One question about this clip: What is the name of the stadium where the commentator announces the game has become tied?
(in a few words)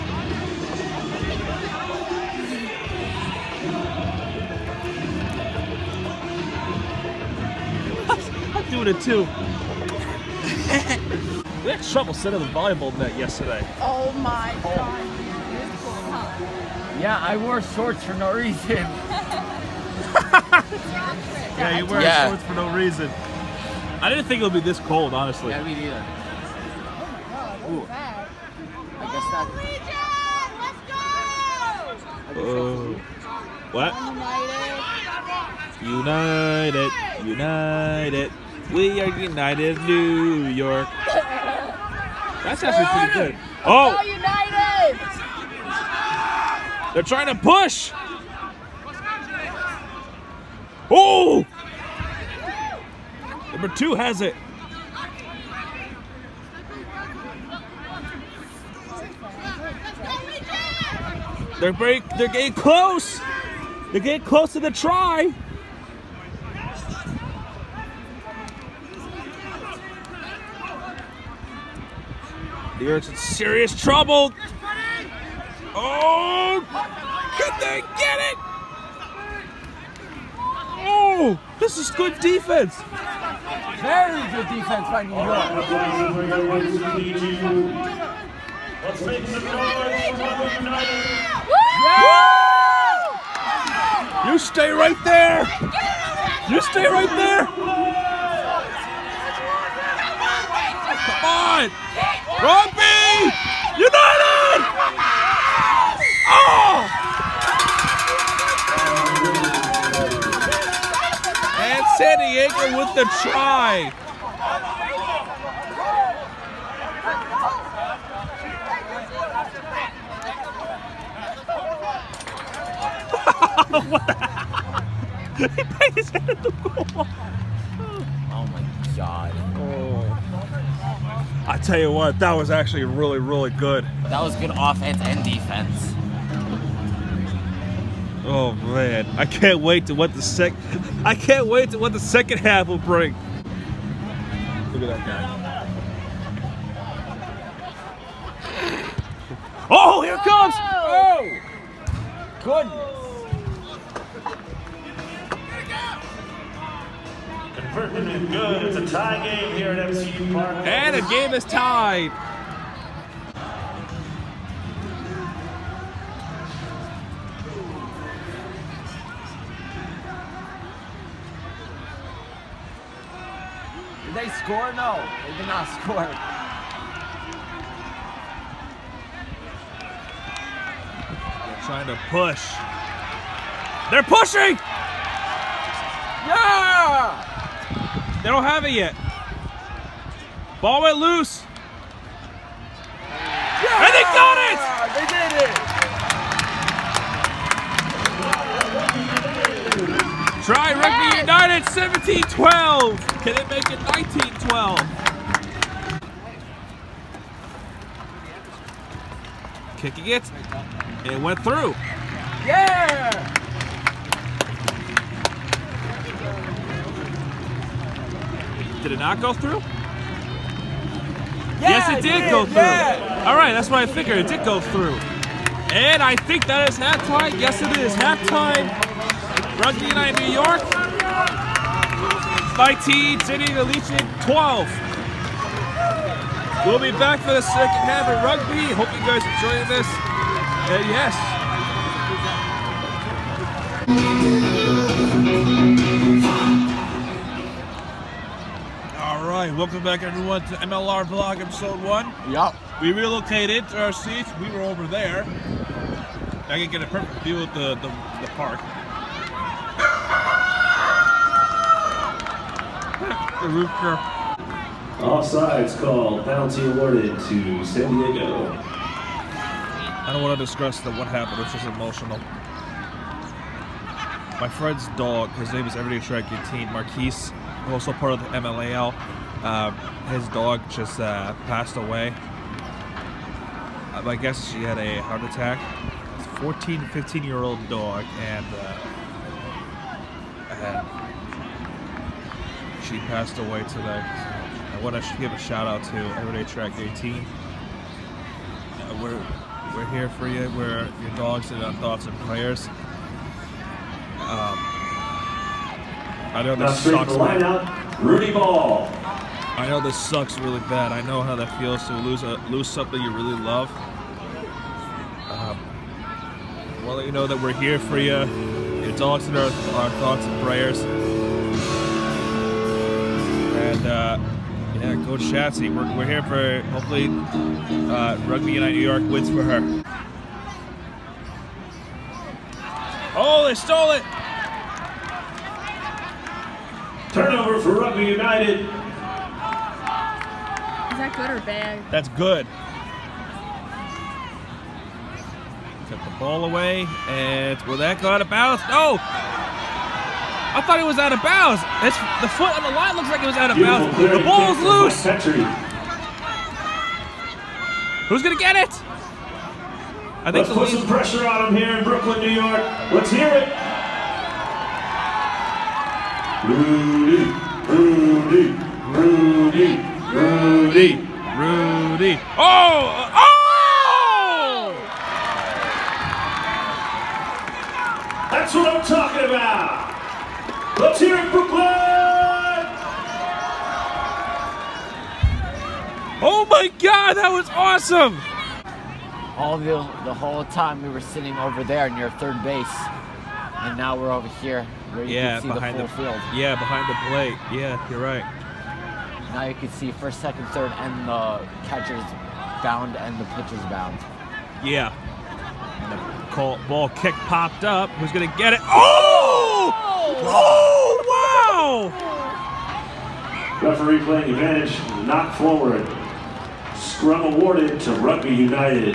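MCU Park.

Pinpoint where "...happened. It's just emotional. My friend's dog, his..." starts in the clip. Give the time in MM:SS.
04:31.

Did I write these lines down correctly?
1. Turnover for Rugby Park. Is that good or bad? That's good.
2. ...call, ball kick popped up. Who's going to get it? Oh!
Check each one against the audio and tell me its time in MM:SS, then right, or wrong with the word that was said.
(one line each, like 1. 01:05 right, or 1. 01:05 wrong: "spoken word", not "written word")
1. 05:37 wrong: "United", not "Park"
2. 06:46 right.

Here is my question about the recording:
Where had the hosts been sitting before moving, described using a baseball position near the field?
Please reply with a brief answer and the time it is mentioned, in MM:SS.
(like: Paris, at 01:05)
Near third base, at 06:31.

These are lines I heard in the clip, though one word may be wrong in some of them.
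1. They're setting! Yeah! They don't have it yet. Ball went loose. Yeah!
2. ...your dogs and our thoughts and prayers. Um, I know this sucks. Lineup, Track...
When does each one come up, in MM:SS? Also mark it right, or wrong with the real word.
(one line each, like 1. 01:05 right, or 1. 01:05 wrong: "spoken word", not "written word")
1. 03:03 wrong: "pushing", not "setting"
2. 05:01 wrong: "Rudy", not "Track".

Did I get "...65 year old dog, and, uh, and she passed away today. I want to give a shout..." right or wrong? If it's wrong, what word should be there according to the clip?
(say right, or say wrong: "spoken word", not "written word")
wrong: "15", not "65".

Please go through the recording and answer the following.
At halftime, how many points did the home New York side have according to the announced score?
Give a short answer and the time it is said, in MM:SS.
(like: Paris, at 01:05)
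19, at 03:52.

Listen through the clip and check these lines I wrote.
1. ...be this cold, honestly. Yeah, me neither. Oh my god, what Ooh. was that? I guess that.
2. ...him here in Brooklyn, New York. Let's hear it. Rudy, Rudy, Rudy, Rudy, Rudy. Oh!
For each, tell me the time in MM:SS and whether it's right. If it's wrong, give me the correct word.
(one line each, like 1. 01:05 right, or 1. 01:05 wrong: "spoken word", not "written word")
1. 00:24 right
2. 06:01 right.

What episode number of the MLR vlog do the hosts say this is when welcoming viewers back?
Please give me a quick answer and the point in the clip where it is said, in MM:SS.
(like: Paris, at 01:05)
1, at 04:11.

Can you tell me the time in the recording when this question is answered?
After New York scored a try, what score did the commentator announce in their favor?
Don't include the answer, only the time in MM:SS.
03:21.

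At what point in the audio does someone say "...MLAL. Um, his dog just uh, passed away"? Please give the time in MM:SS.
04:38.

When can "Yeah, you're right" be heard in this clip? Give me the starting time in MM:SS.
06:37.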